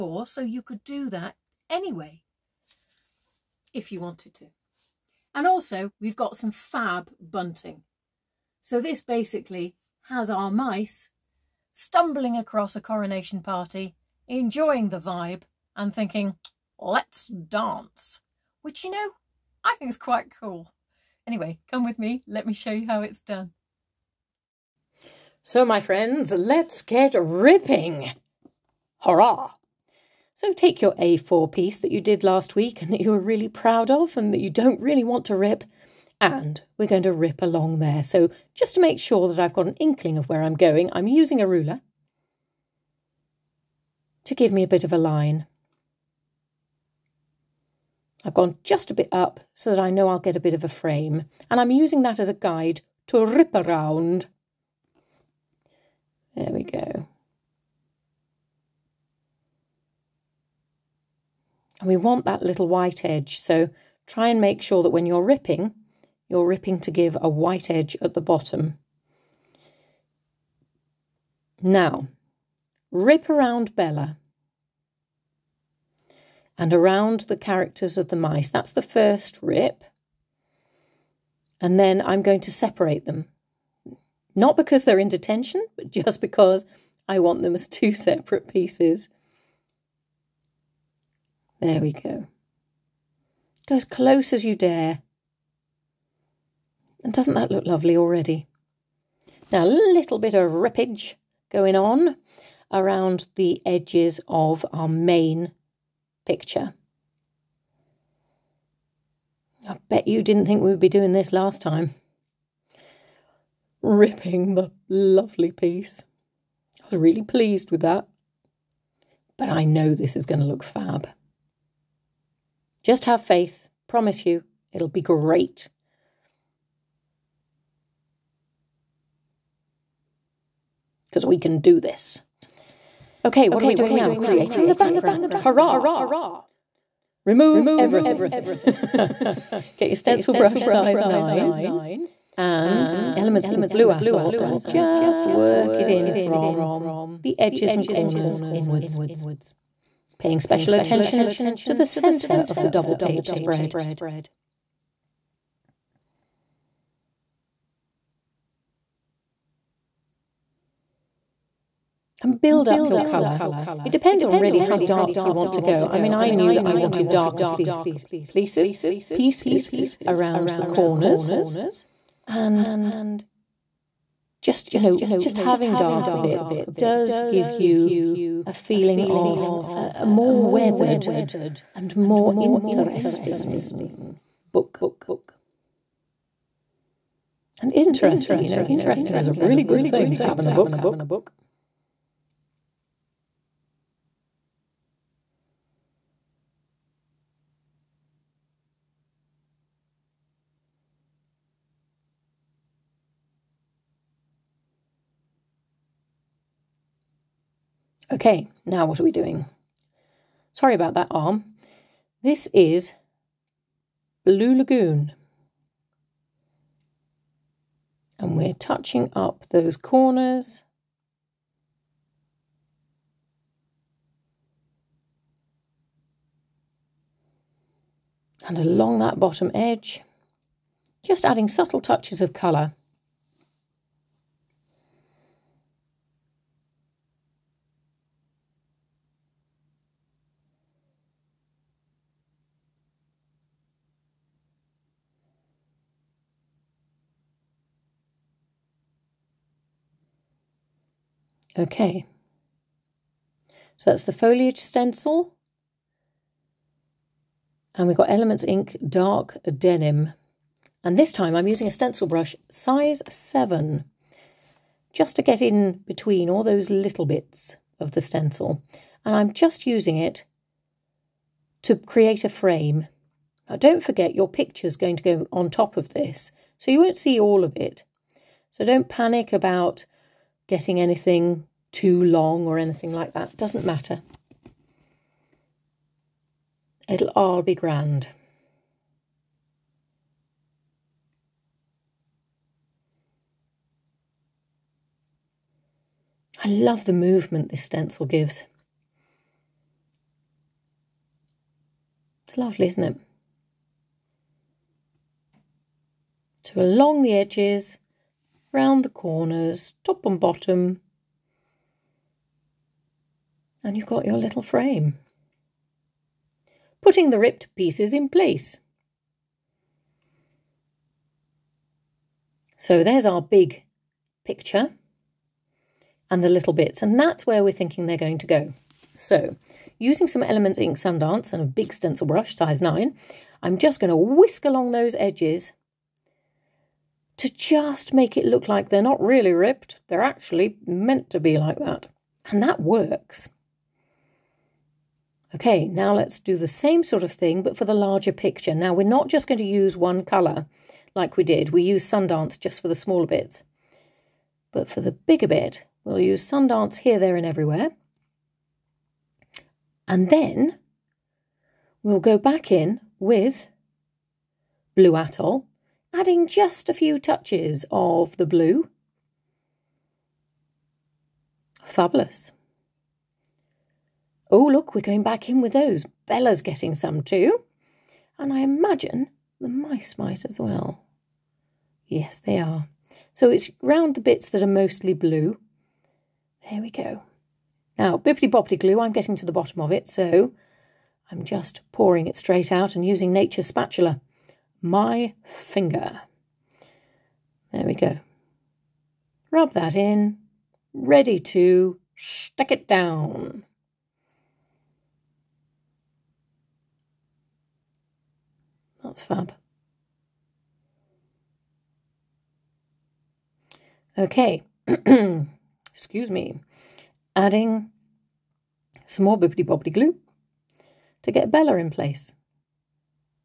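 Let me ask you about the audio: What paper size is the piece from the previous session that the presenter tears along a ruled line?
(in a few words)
A4.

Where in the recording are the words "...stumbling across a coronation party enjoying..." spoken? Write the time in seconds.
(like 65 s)
11 s.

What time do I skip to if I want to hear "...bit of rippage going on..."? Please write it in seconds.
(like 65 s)
100 s.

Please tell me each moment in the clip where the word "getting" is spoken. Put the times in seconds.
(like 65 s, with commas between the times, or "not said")
280 s, 376 s, 388 s.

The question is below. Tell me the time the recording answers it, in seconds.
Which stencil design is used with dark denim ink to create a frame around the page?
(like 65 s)
254 s.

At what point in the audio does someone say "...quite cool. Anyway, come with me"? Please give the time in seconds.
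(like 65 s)
19 s.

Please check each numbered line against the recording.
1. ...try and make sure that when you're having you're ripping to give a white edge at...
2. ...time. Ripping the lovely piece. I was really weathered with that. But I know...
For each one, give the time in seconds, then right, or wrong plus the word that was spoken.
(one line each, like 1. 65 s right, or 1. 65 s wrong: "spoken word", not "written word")
1. 64 s wrong: "ripping", not "having"
2. 111 s wrong: "pleased", not "weathered".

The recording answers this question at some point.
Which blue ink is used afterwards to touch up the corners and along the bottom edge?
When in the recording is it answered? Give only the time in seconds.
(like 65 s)
214 s.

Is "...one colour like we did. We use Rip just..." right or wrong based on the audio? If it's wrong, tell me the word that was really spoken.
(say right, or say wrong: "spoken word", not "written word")
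wrong: "Sundance", not "Rip".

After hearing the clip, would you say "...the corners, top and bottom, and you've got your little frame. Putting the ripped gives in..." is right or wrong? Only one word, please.
wrong.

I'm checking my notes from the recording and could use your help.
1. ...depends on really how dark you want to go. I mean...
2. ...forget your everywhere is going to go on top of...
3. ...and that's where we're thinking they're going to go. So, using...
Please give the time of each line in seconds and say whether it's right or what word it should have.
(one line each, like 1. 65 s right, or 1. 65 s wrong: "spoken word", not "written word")
1. 163 s right
2. 273 s wrong: "picture", not "everywhere"
3. 326 s right.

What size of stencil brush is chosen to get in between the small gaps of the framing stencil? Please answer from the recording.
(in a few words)
7.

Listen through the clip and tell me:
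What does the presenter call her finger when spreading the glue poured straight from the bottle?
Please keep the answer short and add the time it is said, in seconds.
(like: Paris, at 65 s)
nature's spatula, at 393 s.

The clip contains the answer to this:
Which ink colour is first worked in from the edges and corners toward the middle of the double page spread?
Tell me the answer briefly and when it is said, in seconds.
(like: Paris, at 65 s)
Elements Ink Blue Atoll, at 143 s.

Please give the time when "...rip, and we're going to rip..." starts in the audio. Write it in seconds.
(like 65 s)
35 s.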